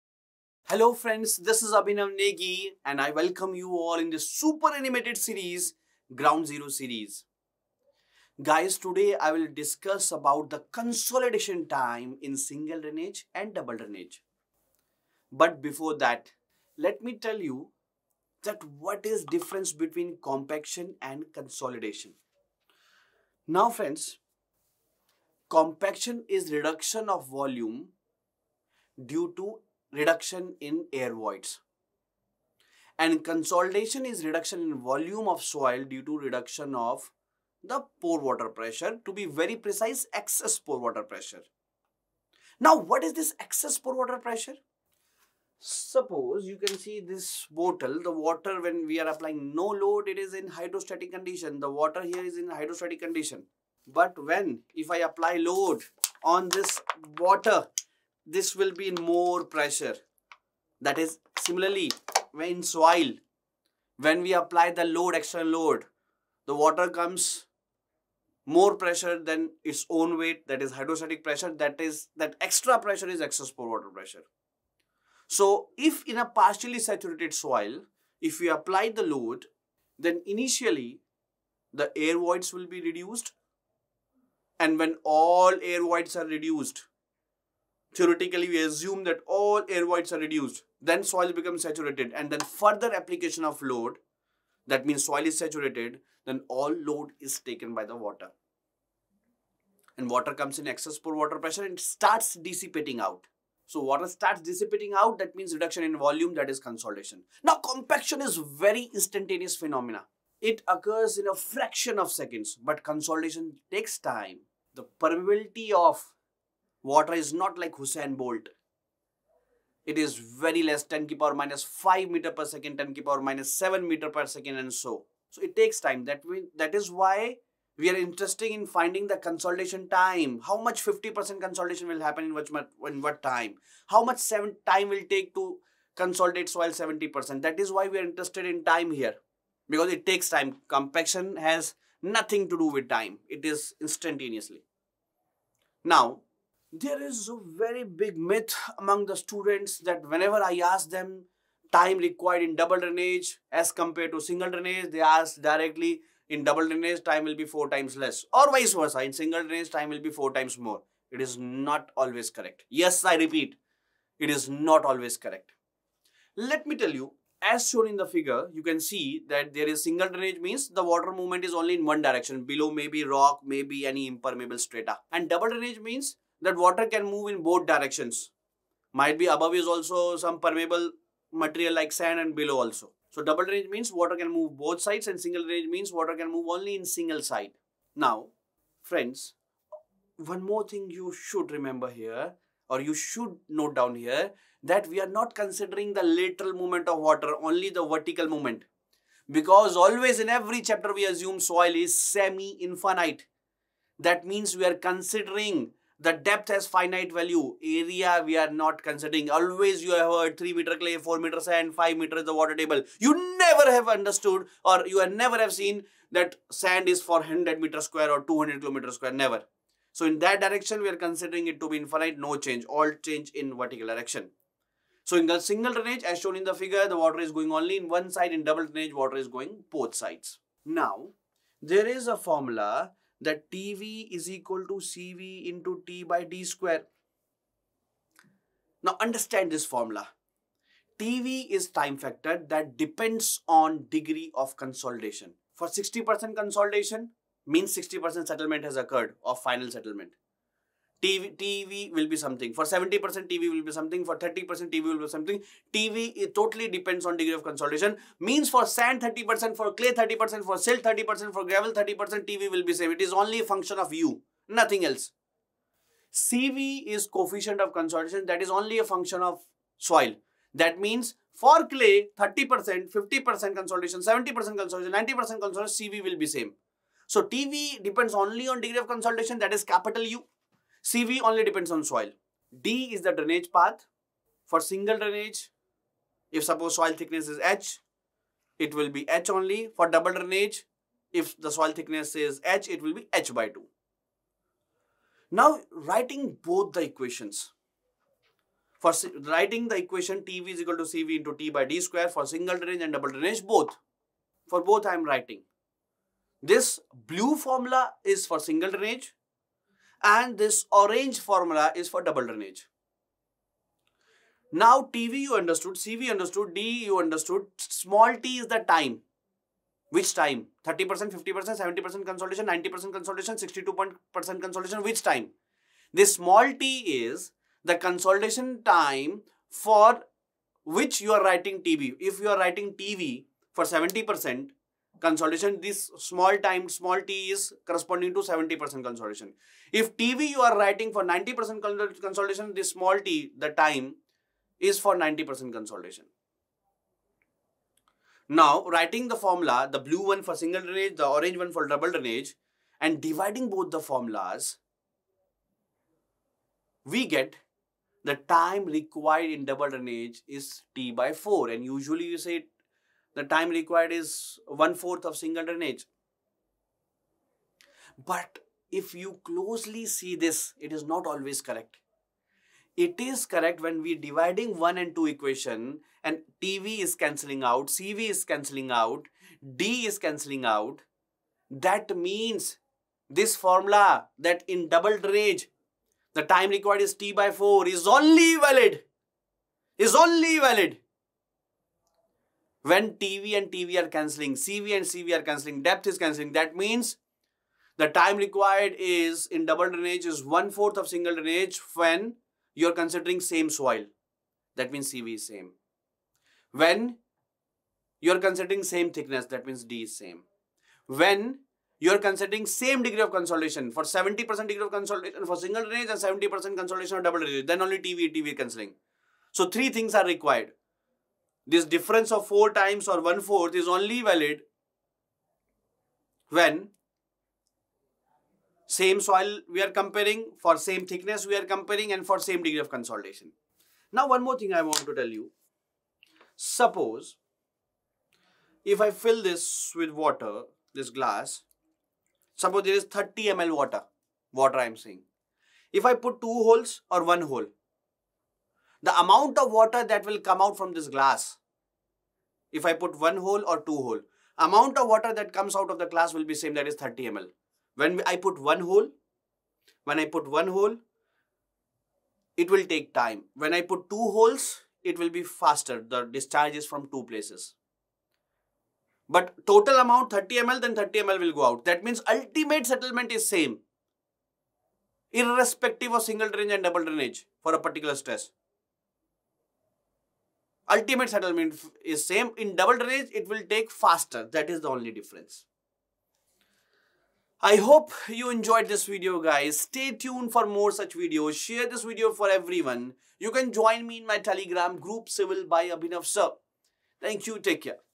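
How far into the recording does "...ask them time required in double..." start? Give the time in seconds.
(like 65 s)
150 s.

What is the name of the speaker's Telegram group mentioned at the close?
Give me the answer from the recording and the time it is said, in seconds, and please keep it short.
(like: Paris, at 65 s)
civil by Abhinav sir, at 495 s.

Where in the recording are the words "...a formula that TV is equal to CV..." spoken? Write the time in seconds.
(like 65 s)
232 s.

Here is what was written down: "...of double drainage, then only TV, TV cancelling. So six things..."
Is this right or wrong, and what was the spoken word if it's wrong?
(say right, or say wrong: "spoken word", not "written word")
wrong: "three", not "six".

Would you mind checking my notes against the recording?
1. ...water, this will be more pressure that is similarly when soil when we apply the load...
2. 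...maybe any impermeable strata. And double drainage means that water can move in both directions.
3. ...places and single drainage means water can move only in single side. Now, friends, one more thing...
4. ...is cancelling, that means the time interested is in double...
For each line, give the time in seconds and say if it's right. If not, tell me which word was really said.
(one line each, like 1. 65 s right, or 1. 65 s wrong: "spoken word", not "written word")
1. 57 s right
2. 173 s right
3. 184 s wrong: "sides", not "places"
4. 395 s wrong: "required", not "interested".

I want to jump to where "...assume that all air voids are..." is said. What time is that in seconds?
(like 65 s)
88 s.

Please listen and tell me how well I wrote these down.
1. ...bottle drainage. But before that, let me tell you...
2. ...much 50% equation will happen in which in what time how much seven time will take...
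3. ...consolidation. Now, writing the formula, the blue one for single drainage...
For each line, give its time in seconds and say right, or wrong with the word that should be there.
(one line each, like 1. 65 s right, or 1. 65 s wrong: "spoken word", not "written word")
1. 13 s wrong: "double", not "bottle"
2. 130 s wrong: "consolidation", not "equation"
3. 345 s right.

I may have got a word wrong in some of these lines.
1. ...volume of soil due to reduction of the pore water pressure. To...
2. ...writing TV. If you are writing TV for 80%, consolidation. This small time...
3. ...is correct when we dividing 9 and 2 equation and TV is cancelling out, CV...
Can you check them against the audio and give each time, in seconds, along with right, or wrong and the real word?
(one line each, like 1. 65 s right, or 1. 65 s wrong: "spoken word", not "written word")
1. 34 s right
2. 331 s wrong: "70", not "80"
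3. 372 s wrong: "1", not "9".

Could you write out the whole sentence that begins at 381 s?
That means this formula that in double drainage, the time required is T by 4 is only valid.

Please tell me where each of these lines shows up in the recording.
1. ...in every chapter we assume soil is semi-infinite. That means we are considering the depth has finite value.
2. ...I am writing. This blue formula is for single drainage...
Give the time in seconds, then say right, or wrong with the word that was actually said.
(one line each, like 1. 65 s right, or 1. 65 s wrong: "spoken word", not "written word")
1. 200 s right
2. 304 s right.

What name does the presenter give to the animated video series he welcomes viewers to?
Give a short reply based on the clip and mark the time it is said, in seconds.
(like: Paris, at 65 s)
Ground Zero series, at 6 s.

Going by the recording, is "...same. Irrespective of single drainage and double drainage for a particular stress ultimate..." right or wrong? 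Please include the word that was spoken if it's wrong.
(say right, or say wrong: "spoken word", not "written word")
right.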